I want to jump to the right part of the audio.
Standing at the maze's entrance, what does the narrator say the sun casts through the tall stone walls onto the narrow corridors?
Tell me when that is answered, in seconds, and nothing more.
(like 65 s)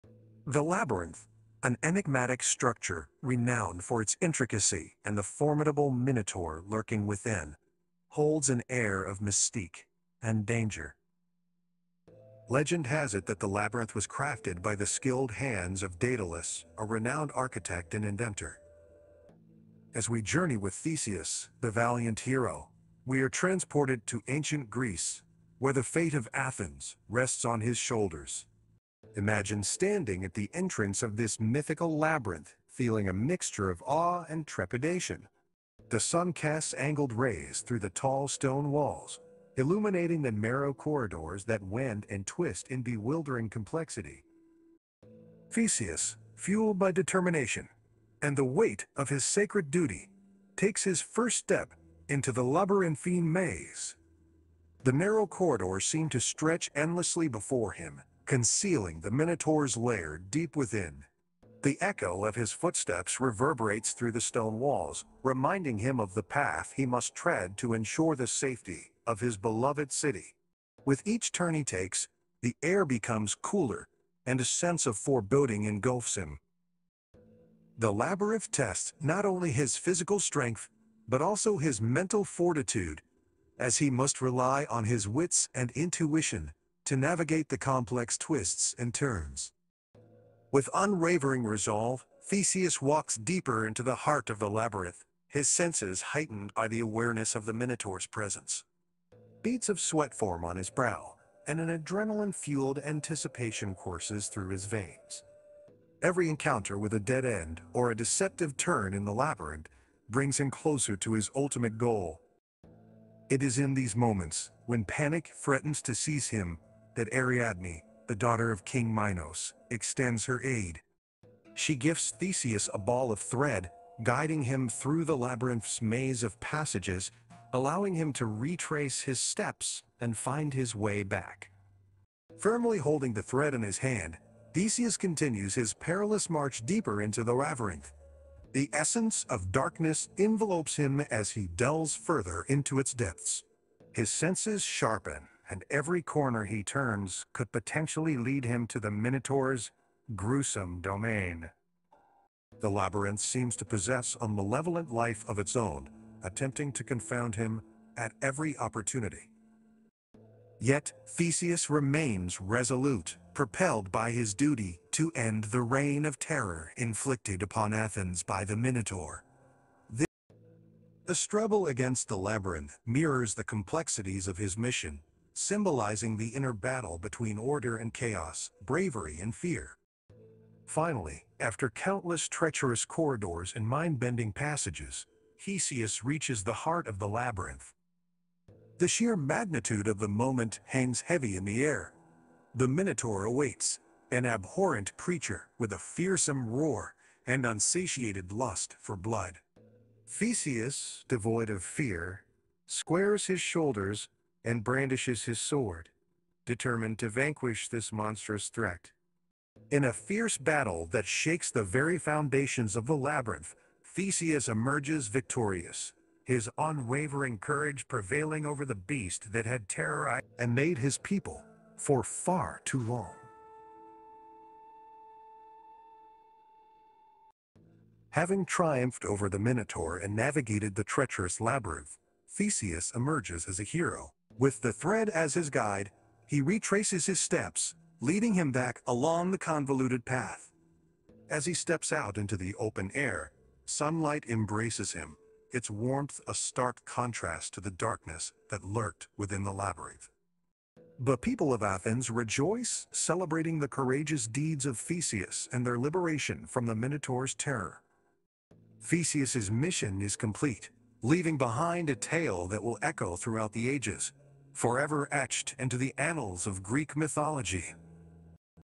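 36 s.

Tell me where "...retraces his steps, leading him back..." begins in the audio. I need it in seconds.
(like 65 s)
236 s.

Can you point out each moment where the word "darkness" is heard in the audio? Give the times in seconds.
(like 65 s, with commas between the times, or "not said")
139 s, 247 s.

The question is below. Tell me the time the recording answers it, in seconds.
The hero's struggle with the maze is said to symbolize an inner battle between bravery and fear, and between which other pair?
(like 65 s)
177 s.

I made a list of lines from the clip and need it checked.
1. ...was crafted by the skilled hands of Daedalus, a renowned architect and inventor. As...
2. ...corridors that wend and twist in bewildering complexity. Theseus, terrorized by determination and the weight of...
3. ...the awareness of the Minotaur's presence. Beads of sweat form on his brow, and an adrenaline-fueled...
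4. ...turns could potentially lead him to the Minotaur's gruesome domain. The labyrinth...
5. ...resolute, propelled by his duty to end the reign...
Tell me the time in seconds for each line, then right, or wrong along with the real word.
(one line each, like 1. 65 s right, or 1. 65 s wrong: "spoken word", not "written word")
1. 13 s right
2. 40 s wrong: "fueled", not "terrorized"
3. 96 s right
4. 146 s right
5. 162 s right.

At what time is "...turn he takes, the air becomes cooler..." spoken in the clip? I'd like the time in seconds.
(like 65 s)
71 s.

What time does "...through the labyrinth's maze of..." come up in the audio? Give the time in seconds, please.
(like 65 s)
124 s.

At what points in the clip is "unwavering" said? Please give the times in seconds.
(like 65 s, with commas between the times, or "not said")
90 s, 216 s.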